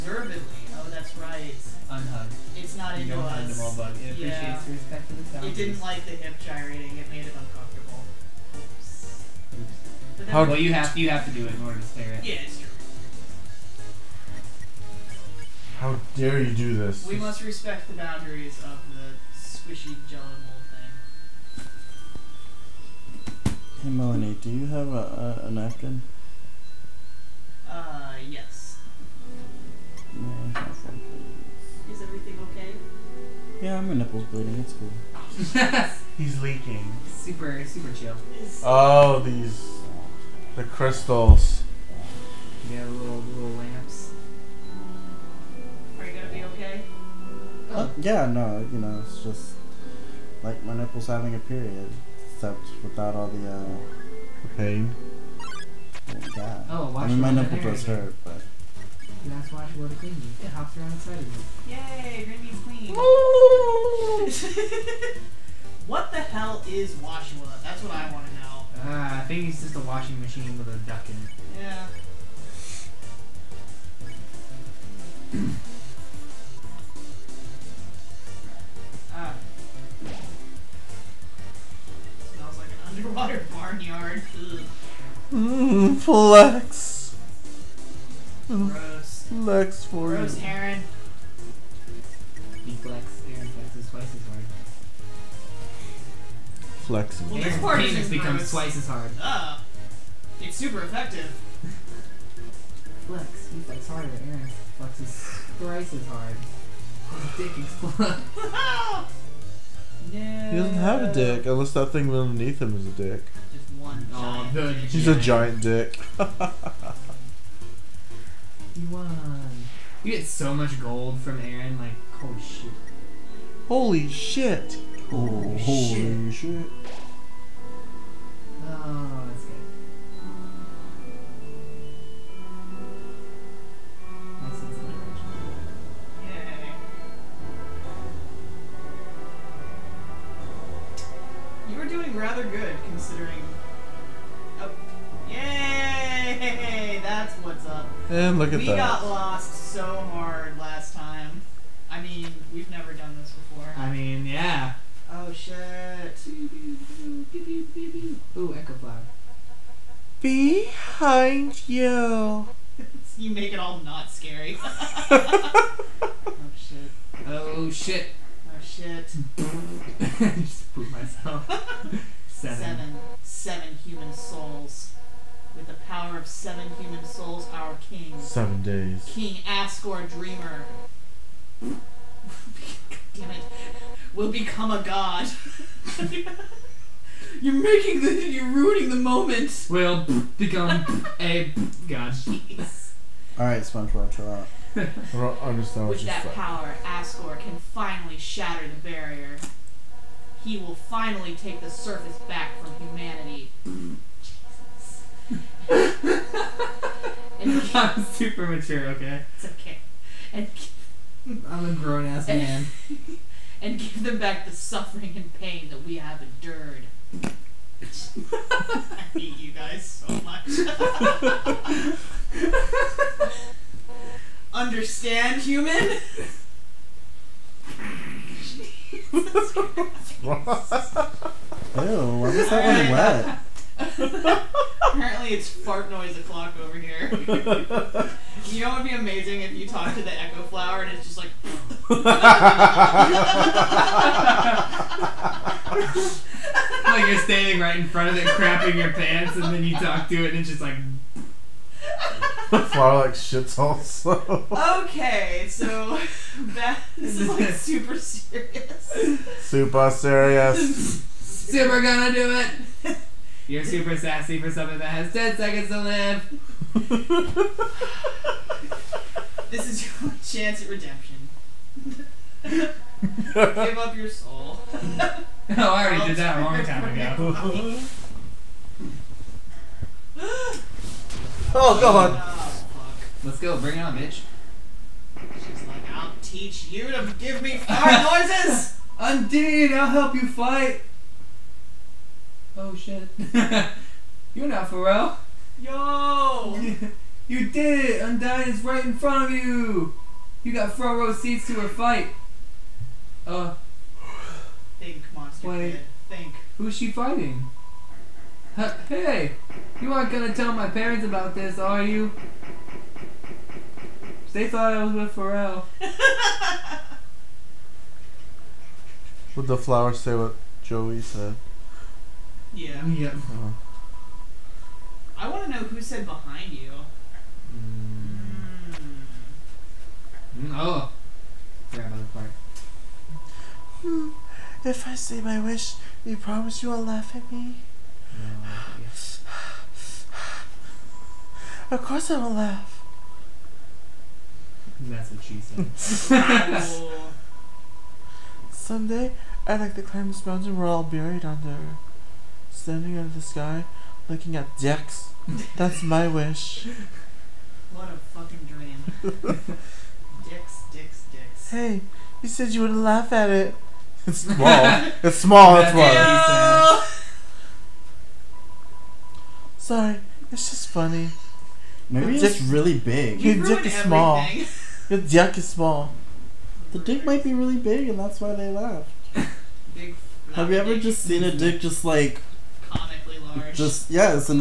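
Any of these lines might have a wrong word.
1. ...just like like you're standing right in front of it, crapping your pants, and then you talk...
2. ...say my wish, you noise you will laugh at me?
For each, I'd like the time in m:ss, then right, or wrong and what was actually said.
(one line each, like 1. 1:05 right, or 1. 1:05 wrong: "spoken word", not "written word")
1. 4:01 right
2. 5:34 wrong: "promise", not "noise".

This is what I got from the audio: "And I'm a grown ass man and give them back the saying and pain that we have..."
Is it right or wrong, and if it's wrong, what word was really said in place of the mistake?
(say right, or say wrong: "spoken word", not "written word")
wrong: "suffering", not "saying".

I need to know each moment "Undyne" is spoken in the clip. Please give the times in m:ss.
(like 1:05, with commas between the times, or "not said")
4:48, 4:58.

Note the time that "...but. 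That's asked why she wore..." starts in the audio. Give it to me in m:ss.
0:58.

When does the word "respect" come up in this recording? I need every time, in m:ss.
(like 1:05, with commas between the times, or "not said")
0:04, 0:17.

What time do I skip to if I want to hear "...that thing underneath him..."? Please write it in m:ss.
1:51.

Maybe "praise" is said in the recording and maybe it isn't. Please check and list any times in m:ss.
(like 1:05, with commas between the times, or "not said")
not said.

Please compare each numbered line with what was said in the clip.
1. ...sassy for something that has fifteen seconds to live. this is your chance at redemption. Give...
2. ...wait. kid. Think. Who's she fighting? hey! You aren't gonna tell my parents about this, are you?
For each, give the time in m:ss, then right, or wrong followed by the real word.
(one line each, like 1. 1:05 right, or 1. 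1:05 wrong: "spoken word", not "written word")
1. 4:23 wrong: "ten", not "fifteen"
2. 5:05 right.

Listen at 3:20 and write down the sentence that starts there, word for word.
He will finally take the surface back from humanity.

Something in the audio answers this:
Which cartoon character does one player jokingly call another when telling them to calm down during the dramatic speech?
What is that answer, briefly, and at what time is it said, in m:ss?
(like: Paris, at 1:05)
SpongeBob, at 3:13.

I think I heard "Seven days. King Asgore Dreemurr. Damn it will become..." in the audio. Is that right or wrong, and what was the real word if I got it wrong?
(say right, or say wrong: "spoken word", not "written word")
right.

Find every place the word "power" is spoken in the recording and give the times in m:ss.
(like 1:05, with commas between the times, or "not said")
2:55, 3:16.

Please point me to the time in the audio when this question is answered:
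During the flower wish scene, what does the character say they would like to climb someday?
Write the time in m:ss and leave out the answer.
5:49.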